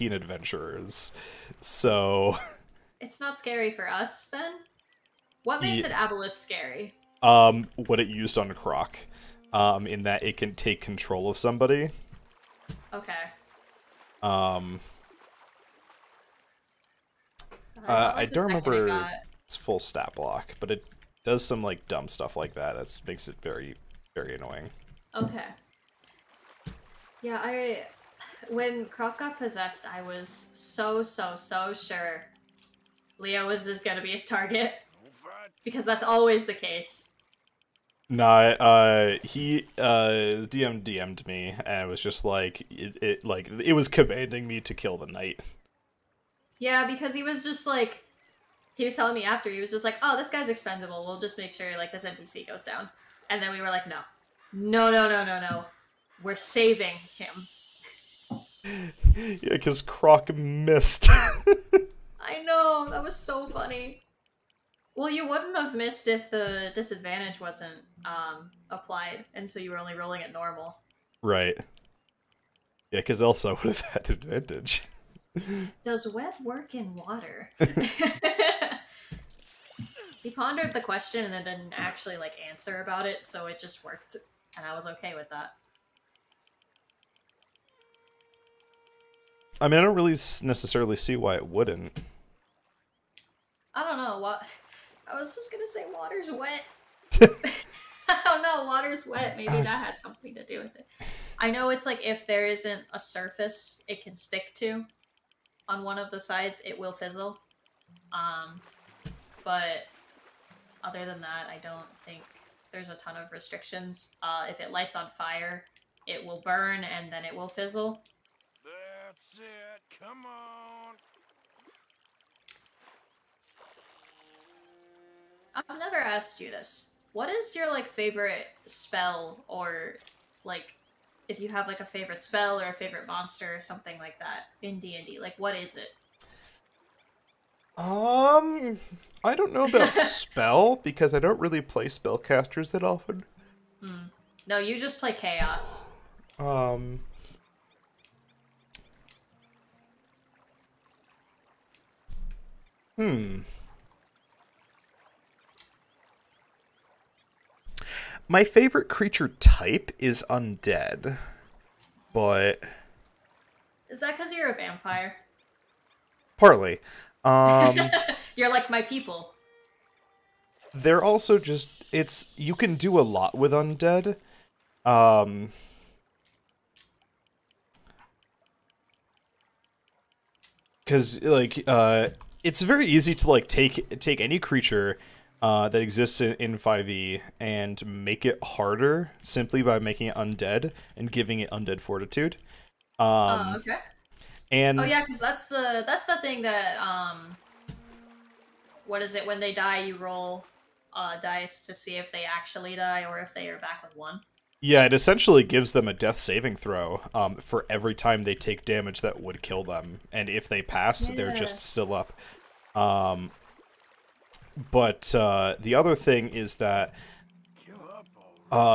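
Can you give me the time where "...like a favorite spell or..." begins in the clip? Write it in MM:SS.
02:11.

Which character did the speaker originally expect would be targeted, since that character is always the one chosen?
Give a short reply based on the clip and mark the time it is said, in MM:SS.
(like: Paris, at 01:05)
Leo, at 00:33.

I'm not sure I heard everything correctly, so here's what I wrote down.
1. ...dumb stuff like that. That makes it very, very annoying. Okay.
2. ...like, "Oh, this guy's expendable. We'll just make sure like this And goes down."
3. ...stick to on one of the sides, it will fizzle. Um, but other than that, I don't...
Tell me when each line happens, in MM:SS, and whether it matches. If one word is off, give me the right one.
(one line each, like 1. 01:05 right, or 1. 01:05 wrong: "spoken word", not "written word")
1. 00:21 right
2. 00:49 wrong: "NPC", not "And"
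3. 01:44 right.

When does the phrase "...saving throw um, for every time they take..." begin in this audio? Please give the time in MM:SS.
03:26.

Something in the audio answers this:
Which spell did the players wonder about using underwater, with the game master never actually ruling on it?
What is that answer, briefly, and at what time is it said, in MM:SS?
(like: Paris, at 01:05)
web, at 01:16.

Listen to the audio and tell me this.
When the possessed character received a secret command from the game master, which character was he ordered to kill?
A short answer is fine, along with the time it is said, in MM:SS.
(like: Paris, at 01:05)
the knight, at 00:44.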